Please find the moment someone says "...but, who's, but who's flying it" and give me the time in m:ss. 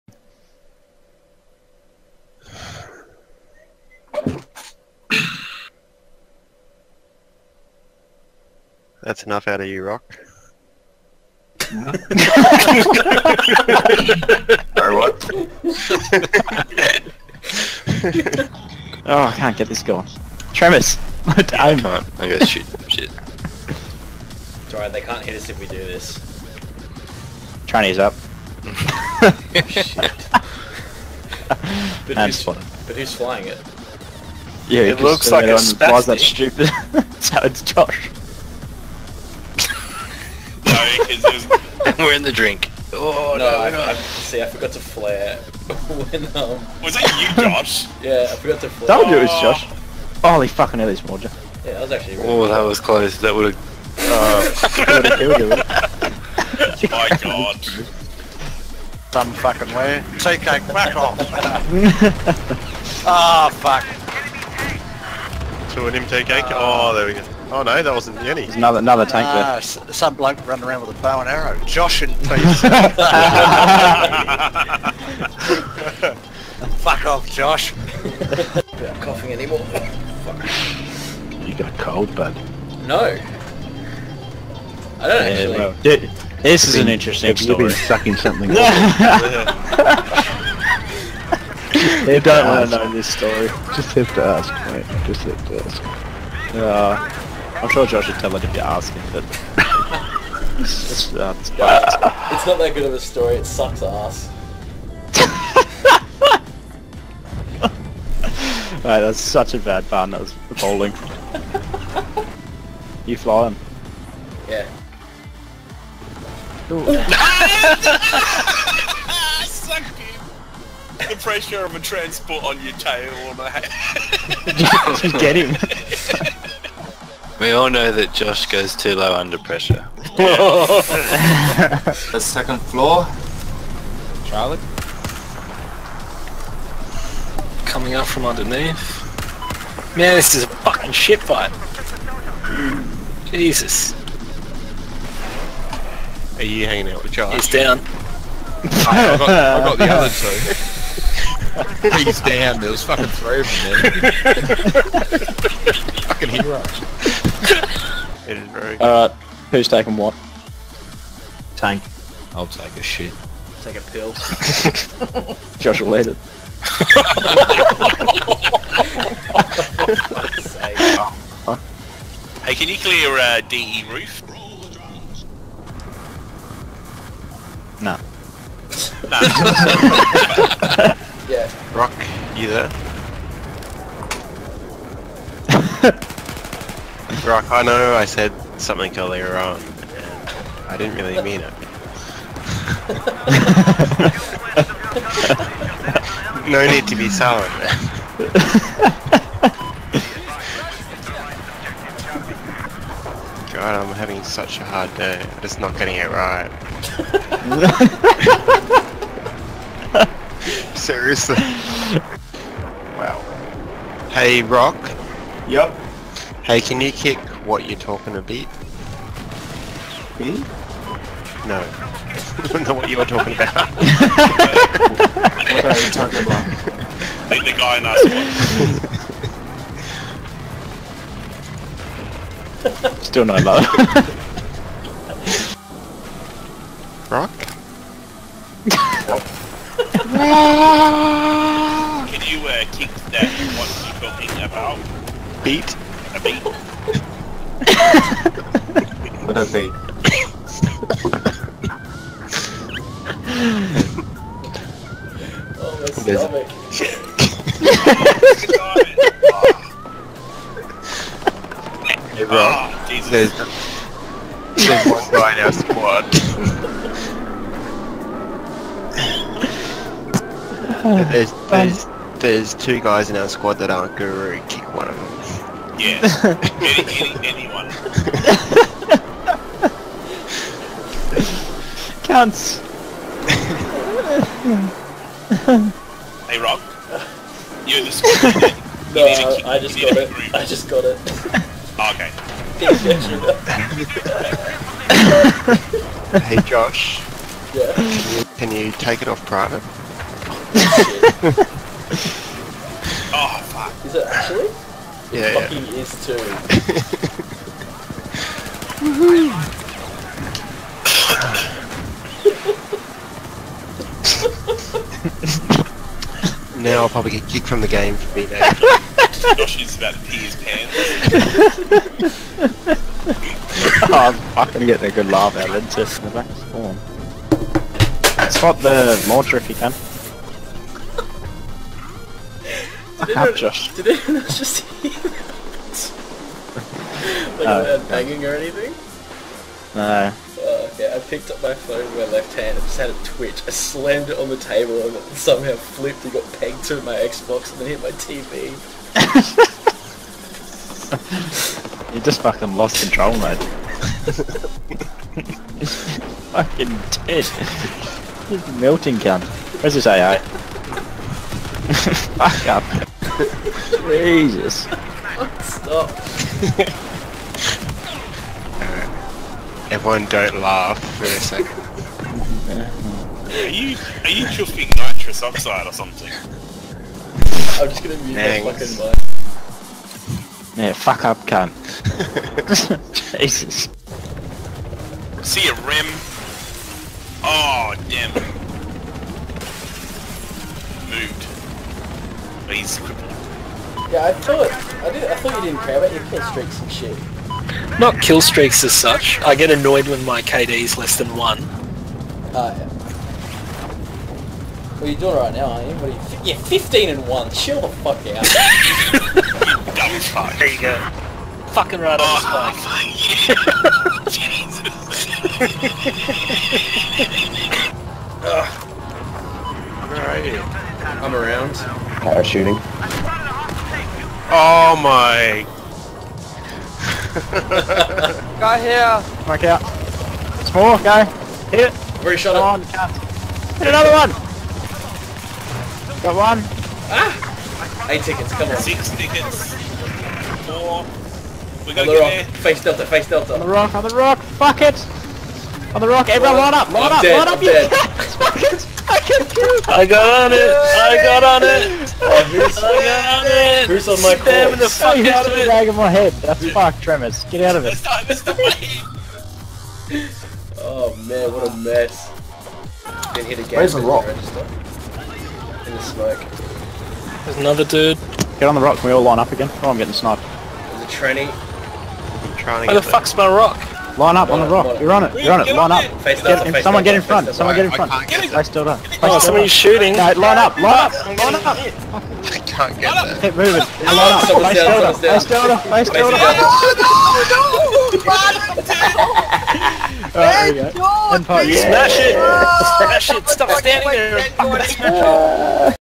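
0:29.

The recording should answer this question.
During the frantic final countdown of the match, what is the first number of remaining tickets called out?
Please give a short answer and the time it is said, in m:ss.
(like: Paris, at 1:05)
8, at 7:17.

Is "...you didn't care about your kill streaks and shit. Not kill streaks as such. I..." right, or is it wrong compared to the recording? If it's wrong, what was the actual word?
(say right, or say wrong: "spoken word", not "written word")
right.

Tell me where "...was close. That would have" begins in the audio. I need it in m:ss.
0:52.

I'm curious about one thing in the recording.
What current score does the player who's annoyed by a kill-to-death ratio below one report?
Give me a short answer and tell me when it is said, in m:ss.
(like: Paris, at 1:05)
15 and 1, at 6:46.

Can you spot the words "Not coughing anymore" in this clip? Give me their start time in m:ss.
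1:18.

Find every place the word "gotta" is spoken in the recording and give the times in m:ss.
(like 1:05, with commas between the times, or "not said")
0:22, 7:21.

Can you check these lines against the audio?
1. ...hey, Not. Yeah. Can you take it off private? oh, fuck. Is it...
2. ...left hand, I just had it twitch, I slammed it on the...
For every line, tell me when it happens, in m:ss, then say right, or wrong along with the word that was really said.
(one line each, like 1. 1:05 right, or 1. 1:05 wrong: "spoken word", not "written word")
1. 4:56 wrong: "Josh", not "Not"
2. 5:42 right.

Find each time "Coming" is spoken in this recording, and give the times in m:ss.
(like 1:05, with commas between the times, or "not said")
2:17.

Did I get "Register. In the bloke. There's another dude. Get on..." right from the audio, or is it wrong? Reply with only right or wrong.
wrong.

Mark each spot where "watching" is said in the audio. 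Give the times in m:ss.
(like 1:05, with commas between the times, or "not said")
not said.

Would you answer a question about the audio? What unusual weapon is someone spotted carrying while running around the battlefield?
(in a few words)
bow and arrow.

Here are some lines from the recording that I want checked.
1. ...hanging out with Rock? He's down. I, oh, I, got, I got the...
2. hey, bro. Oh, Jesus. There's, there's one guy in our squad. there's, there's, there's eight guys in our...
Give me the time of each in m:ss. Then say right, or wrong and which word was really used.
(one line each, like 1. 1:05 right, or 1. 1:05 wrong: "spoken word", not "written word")
1. 2:26 wrong: "Josh", not "Rock"
2. 4:22 wrong: "two", not "eight".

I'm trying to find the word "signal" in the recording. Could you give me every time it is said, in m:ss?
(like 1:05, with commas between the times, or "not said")
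not said.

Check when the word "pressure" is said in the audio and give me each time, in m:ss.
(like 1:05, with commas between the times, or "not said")
2:01, 2:09.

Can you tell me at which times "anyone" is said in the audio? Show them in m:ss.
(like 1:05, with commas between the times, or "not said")
4:37, 5:33.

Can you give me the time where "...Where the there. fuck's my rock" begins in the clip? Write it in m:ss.
7:52.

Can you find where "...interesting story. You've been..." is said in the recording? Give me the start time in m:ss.
1:26.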